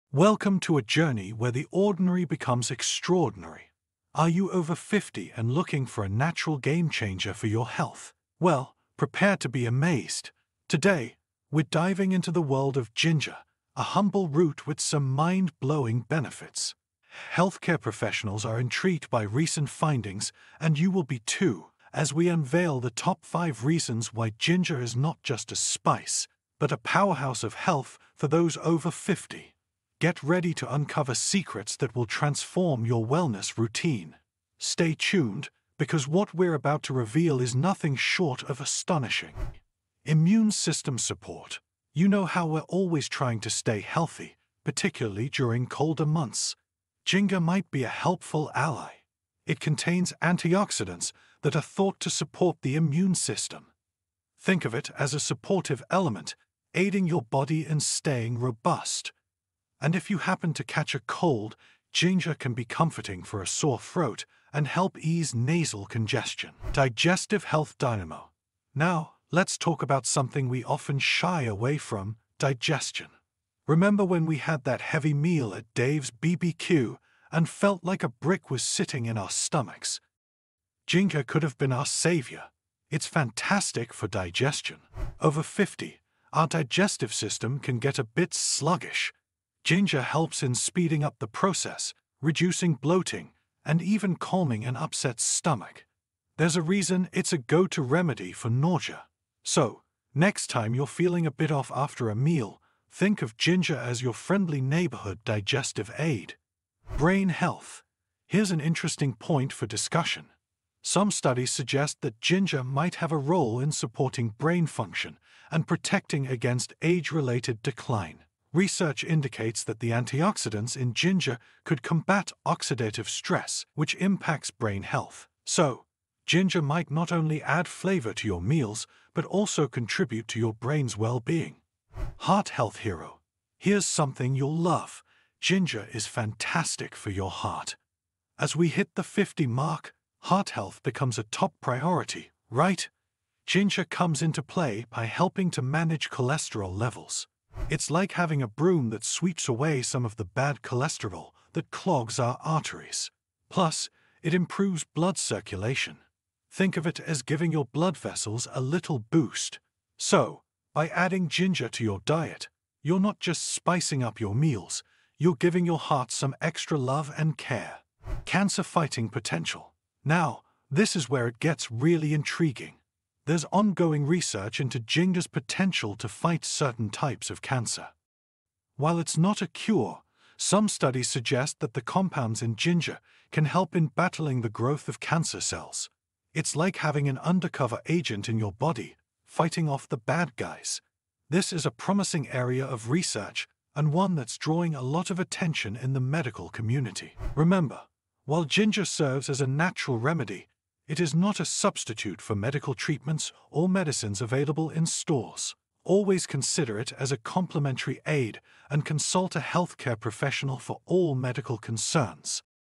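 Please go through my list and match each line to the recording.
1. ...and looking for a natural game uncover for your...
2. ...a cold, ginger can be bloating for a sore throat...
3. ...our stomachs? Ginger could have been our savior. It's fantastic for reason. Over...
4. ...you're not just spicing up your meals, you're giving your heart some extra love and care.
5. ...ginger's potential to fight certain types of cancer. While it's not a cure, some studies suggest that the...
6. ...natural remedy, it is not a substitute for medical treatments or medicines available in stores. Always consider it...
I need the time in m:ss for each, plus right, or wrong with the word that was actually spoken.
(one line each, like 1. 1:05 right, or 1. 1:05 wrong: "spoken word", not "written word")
1. 0:05 wrong: "changer", not "uncover"
2. 1:00 wrong: "comforting", not "bloating"
3. 1:19 wrong: "digestion", not "reason"
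4. 2:42 right
5. 2:54 right
6. 3:19 right.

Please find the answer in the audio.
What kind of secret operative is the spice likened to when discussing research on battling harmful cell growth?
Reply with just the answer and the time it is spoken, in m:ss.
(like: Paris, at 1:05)
Undercover agent, at 3:07.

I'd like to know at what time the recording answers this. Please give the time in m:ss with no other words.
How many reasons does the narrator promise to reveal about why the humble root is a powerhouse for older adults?
0:22.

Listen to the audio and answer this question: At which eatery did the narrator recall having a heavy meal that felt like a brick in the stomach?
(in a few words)
Dave's BBQ.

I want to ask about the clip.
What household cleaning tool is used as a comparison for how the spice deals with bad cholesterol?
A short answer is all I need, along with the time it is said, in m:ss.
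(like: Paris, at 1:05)
Broom, at 2:28.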